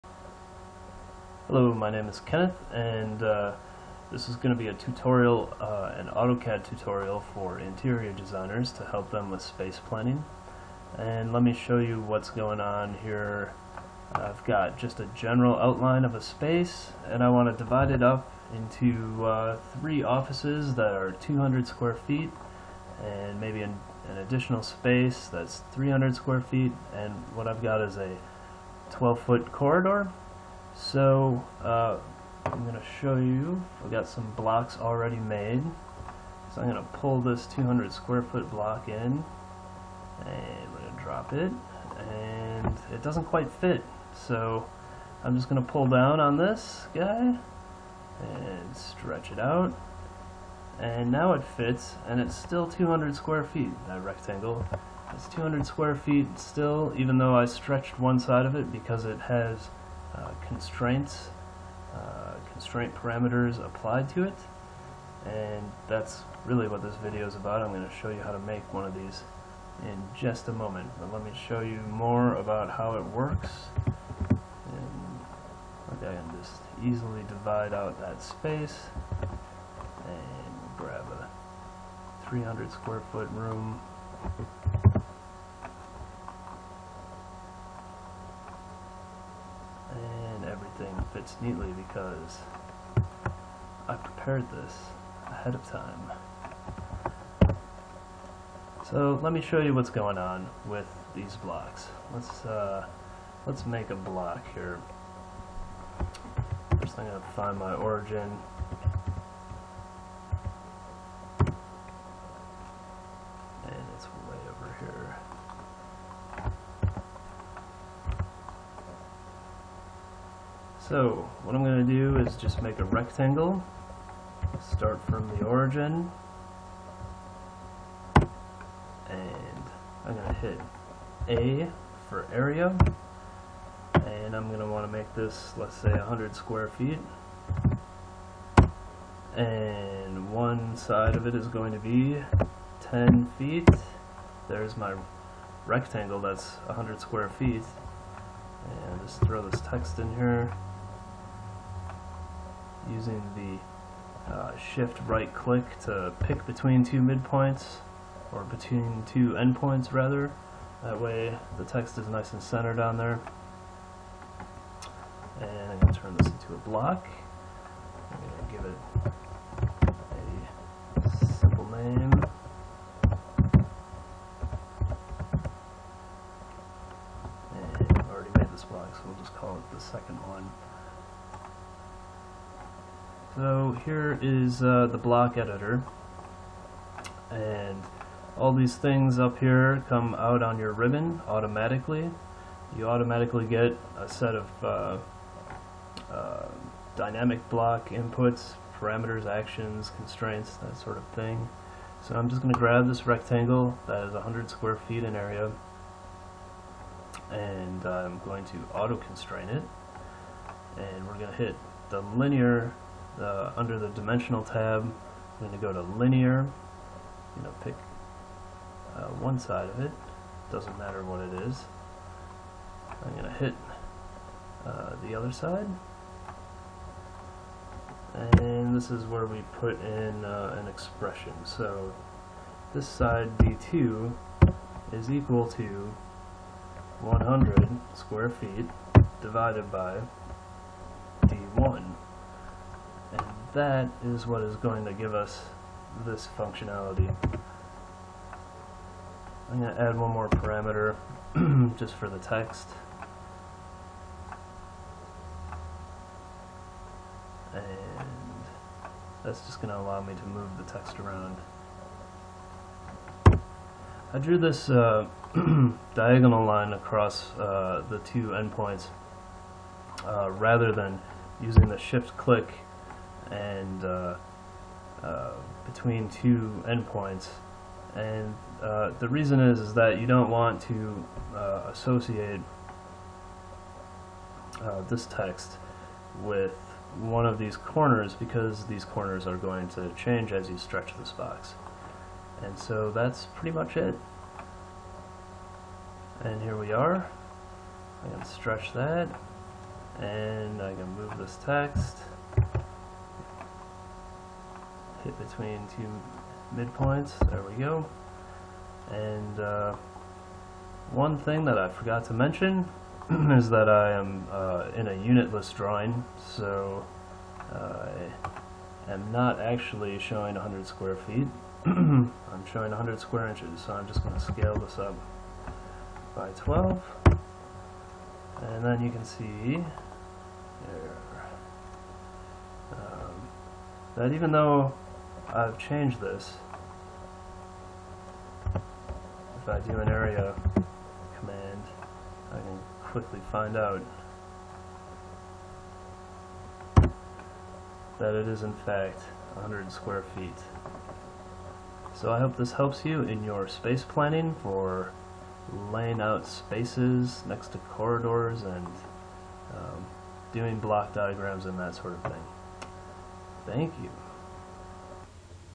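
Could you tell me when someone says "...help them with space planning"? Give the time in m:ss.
0:08.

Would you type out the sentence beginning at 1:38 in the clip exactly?
So let me show you what's going on with these blocks.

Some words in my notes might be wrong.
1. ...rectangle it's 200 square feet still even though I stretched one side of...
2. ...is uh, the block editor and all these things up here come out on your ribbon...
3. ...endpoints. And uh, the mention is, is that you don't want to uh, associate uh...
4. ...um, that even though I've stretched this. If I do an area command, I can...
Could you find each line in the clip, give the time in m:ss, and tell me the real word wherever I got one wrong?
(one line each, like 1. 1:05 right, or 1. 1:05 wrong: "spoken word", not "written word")
1. 0:54 right
2. 3:04 right
3. 4:36 wrong: "reason", not "mention"
4. 5:32 wrong: "changed", not "stretched".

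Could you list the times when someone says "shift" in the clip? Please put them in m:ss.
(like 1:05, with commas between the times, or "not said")
2:34, 4:31.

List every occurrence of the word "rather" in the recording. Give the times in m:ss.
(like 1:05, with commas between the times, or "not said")
2:39, 4:30.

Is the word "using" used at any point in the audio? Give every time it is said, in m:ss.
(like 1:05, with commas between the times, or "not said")
2:32, 4:31.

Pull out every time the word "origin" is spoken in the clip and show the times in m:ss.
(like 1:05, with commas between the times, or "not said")
1:47, 2:05.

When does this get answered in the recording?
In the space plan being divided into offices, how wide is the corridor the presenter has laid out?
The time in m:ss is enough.
0:28.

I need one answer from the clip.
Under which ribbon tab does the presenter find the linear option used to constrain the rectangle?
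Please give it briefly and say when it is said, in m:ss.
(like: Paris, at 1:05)
dimensional, at 3:33.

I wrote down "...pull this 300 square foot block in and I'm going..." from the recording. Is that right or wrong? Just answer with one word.
wrong.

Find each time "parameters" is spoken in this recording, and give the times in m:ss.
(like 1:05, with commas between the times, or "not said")
1:02, 3:18, 4:10.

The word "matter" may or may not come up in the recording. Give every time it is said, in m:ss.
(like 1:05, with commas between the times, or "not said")
3:40.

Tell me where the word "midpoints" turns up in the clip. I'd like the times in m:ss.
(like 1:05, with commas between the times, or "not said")
2:37, 5:06.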